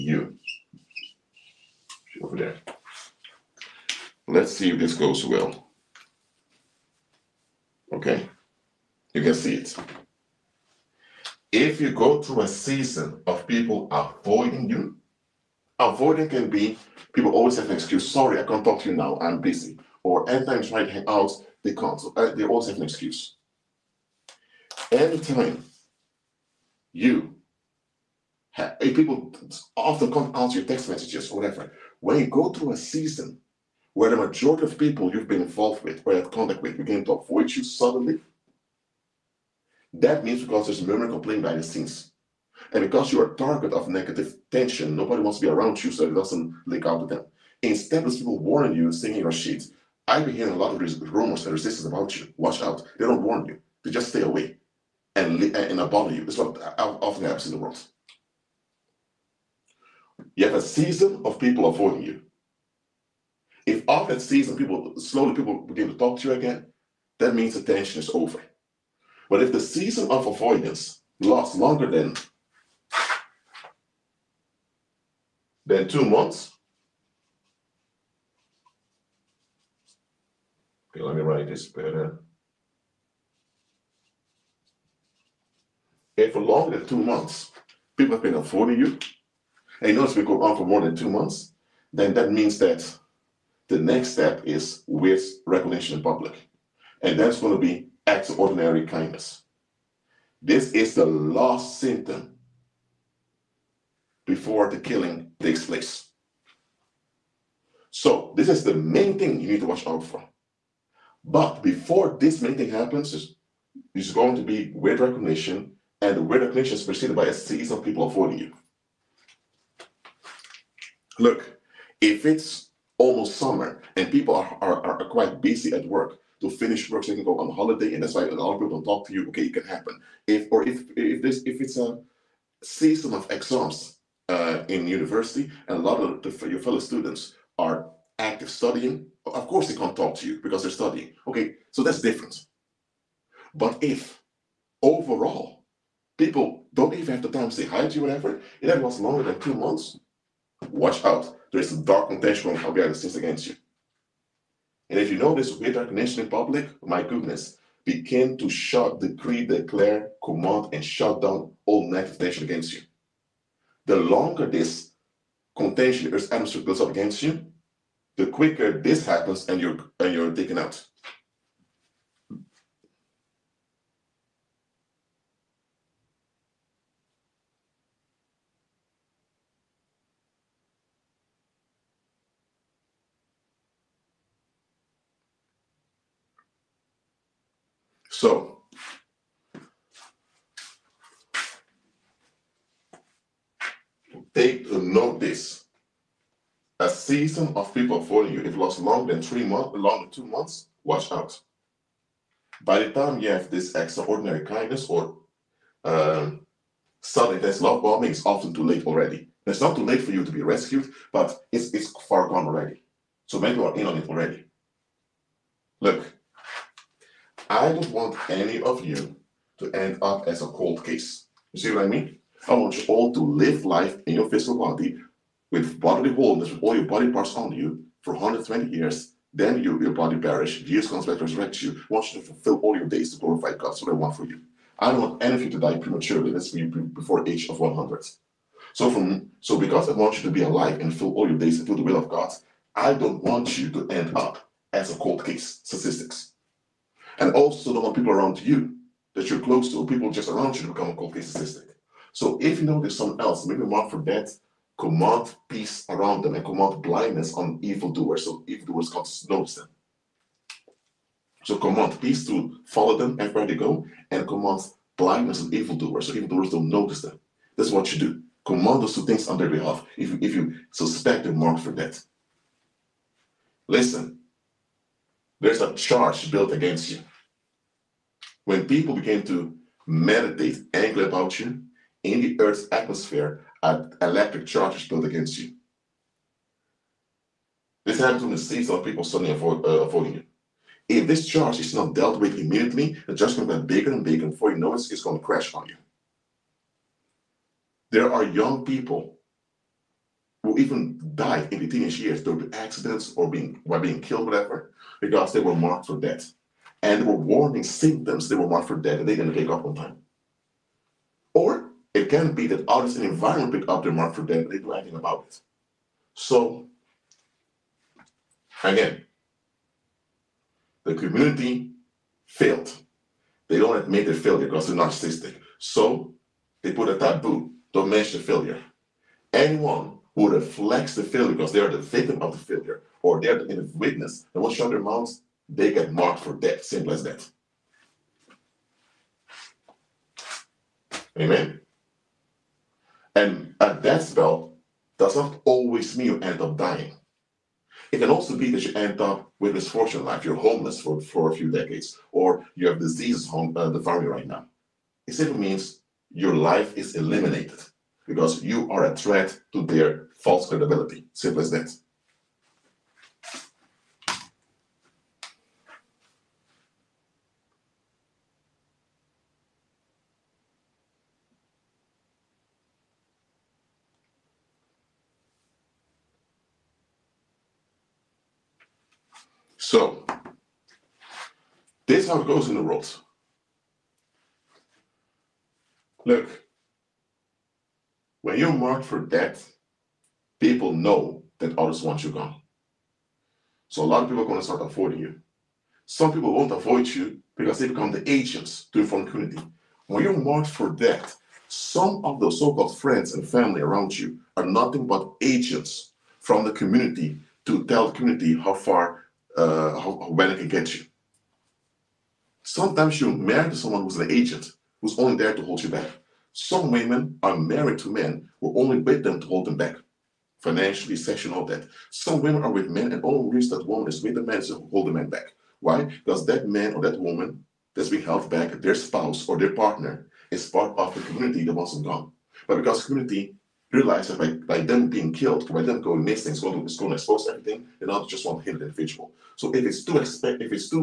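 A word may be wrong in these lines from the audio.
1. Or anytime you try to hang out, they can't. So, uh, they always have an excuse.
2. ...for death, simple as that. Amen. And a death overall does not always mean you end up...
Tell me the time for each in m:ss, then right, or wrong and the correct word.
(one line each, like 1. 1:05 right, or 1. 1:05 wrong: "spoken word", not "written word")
1. 0:20 right
2. 5:36 wrong: "spell", not "overall".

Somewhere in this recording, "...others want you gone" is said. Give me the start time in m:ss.
6:31.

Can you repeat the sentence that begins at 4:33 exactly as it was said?
Listen, there's a charge built against you.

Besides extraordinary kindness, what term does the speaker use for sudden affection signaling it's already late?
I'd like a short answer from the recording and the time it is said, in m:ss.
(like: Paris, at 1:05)
love bombing, at 3:27.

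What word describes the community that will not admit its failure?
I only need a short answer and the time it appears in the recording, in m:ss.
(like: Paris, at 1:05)
narcissistic, at 5:24.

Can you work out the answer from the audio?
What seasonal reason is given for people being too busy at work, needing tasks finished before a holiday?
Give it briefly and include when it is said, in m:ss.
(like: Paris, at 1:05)
almost summer, at 2:02.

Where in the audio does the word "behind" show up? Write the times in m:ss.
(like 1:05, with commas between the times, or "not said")
0:41, 2:32.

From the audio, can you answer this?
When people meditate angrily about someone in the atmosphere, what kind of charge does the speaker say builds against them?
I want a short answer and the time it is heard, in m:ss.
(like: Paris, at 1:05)
electric charge, at 4:44.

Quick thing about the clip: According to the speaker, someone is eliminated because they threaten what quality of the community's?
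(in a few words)
false credibility.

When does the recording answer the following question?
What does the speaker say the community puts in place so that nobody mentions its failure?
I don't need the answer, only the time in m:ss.
5:26.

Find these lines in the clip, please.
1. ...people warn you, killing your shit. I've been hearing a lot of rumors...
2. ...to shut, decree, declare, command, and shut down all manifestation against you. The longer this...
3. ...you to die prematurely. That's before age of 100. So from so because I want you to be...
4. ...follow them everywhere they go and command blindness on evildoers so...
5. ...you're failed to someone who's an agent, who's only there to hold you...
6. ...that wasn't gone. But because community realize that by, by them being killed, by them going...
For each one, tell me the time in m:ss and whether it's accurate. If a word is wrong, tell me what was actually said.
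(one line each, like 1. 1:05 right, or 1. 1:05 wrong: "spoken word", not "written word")
1. 0:48 wrong: "singing", not "killing"
2. 2:38 right
3. 3:55 right
4. 4:22 right
5. 6:52 wrong: "married", not "failed"
6. 7:11 right.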